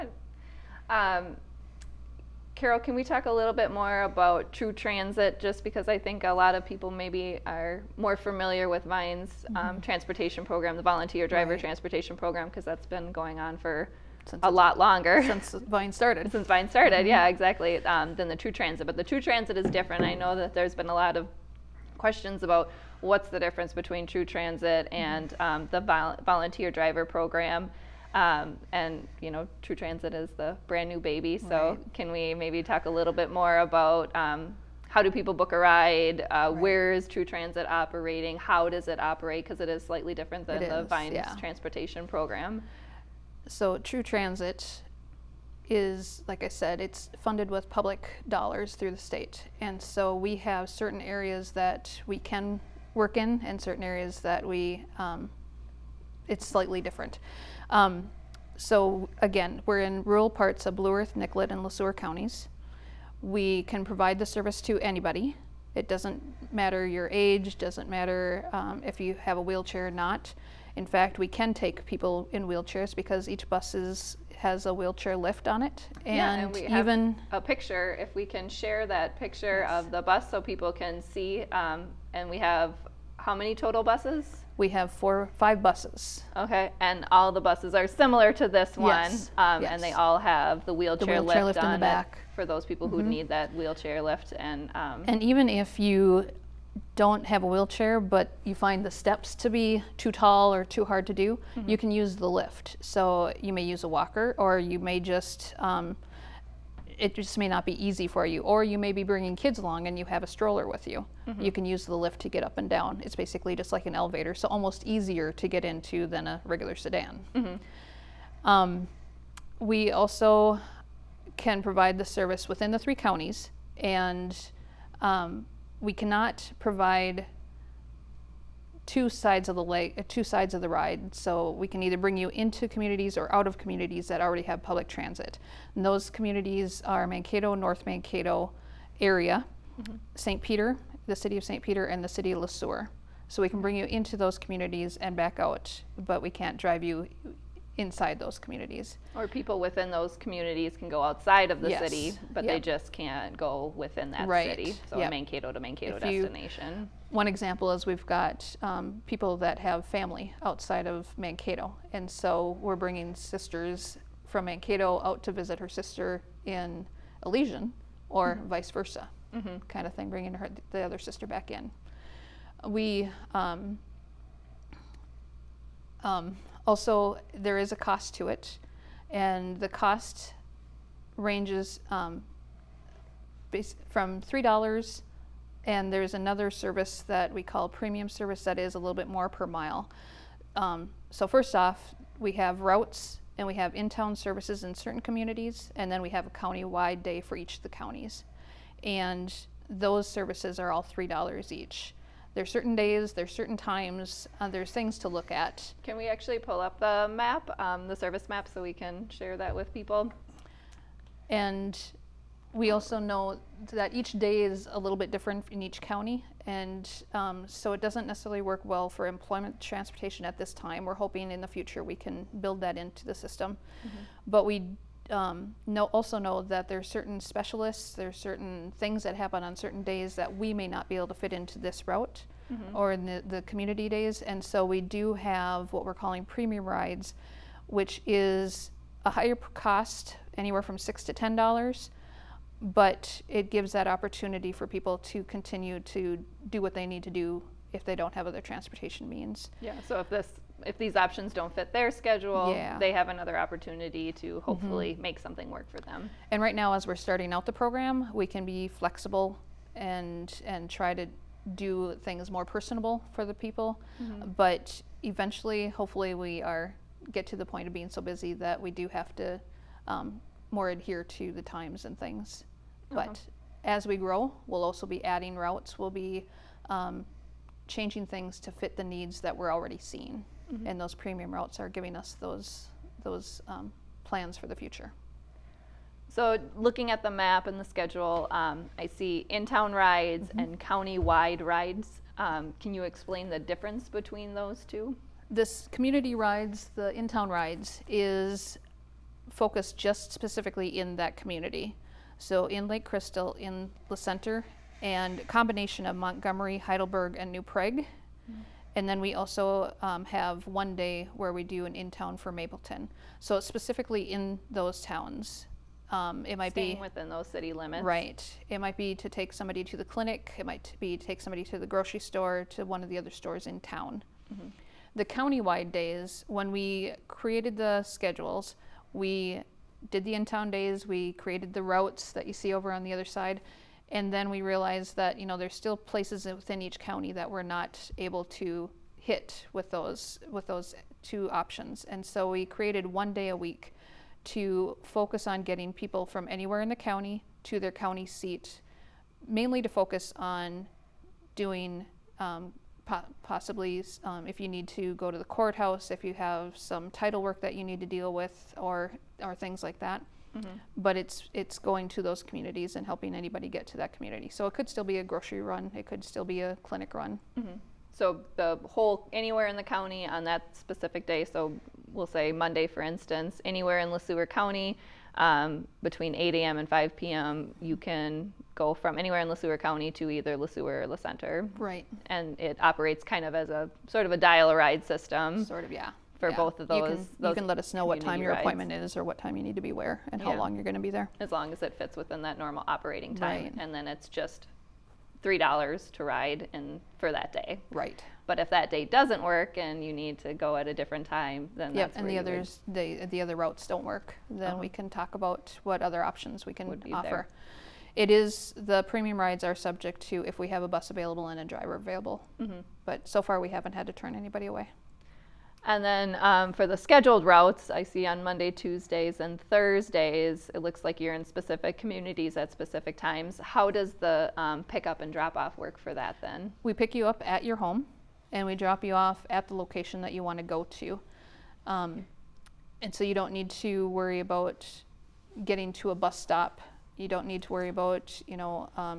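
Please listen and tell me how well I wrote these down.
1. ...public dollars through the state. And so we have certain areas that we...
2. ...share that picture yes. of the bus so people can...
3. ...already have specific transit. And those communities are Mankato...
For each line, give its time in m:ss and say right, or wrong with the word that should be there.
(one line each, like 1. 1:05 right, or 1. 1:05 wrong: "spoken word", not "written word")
1. 0:47 right
2. 1:18 right
3. 2:14 wrong: "public", not "specific".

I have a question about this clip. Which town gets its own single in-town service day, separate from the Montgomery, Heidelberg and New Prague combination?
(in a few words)
Mapleton.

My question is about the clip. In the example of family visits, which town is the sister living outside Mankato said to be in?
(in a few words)
Elysian.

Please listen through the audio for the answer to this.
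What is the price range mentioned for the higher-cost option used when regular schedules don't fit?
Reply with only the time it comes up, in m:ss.
4:00.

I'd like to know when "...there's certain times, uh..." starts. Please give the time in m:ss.
3:23.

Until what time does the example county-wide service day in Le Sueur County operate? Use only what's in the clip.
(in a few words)
5 p.m.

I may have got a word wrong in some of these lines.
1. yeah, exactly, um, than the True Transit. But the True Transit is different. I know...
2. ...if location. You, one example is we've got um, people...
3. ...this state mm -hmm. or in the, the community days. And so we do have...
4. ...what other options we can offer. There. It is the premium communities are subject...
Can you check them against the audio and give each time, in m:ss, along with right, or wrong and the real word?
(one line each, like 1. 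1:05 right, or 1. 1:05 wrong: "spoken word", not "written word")
1. 0:17 right
2. 2:35 wrong: "destination", not "location"
3. 3:51 wrong: "route", not "state"
4. 6:45 wrong: "rides", not "communities".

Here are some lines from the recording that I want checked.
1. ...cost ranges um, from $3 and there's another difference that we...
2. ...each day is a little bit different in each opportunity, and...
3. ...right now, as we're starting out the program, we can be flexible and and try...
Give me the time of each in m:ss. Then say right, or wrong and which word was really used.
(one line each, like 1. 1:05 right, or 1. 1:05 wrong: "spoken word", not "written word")
1. 2:59 wrong: "service", not "difference"
2. 3:33 wrong: "county", not "opportunity"
3. 4:16 right.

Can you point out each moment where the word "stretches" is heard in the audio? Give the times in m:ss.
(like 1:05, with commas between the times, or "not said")
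not said.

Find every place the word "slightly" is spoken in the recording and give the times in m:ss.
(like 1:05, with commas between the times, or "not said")
0:39, 0:56.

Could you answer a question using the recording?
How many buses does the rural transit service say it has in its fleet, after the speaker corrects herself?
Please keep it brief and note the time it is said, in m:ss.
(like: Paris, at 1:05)
5, at 1:25.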